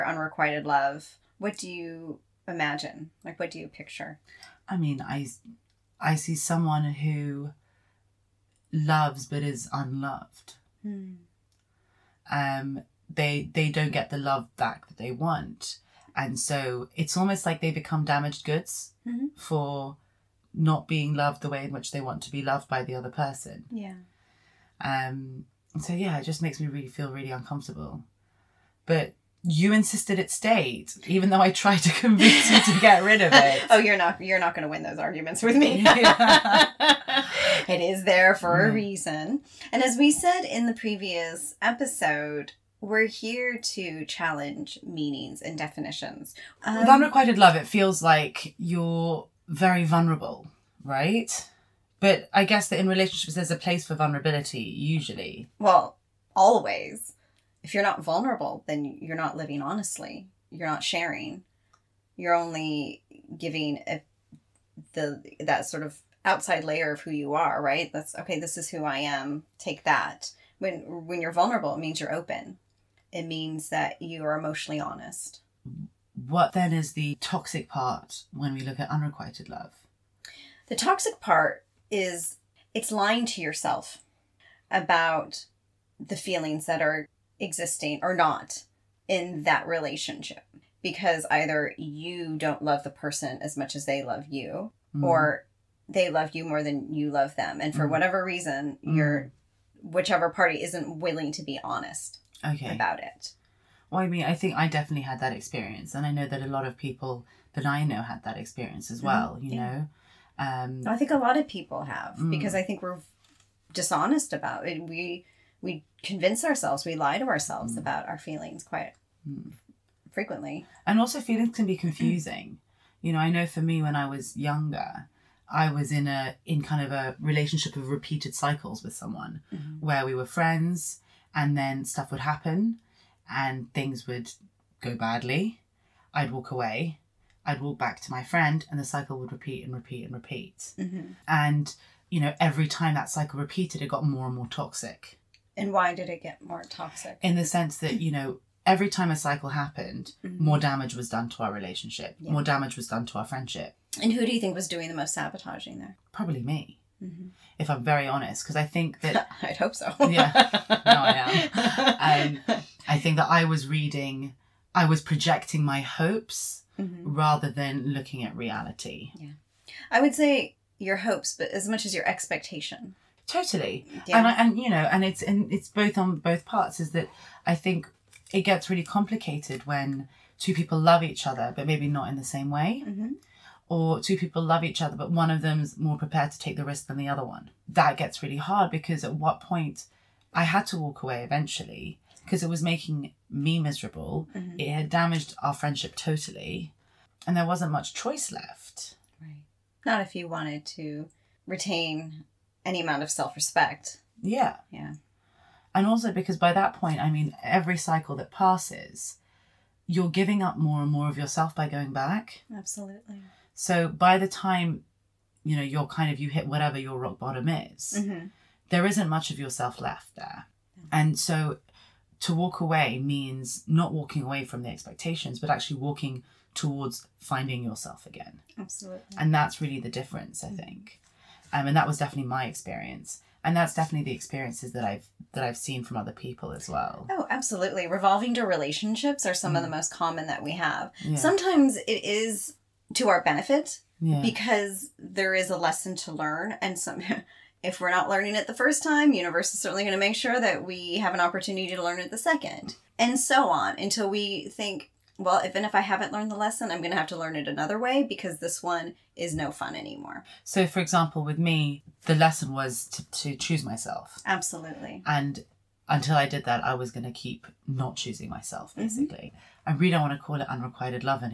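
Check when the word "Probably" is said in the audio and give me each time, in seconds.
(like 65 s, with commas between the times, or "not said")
156 s.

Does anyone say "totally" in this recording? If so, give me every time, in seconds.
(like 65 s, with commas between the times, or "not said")
173 s, 195 s.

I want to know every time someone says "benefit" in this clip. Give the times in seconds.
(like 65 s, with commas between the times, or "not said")
243 s.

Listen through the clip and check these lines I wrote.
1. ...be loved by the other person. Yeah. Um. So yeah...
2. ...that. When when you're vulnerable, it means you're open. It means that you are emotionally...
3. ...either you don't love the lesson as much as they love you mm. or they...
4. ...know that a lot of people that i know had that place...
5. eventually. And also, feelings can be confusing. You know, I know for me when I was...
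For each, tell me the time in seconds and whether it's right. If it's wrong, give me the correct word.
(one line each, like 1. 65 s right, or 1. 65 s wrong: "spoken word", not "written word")
1. 22 s right
2. 69 s right
3. 91 s wrong: "person", not "lesson"
4. 106 s wrong: "experience", not "place"
5. 120 s wrong: "frequently", not "eventually".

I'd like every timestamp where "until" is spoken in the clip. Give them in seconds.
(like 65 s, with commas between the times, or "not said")
253 s, 265 s.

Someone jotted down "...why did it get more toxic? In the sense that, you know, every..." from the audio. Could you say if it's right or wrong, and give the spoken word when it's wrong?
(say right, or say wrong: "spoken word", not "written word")
right.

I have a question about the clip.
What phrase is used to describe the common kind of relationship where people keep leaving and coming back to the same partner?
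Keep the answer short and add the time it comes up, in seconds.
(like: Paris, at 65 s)
revolving door relationships, at 237 s.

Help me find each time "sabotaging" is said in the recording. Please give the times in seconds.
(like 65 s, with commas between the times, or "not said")
155 s.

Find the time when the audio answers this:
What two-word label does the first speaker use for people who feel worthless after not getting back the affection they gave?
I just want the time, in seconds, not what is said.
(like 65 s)
18 s.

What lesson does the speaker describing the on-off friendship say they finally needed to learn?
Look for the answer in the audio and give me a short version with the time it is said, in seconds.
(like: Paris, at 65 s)
choose myself, at 263 s.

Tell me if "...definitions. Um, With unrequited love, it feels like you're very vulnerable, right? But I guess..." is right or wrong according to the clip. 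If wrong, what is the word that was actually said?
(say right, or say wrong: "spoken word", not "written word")
right.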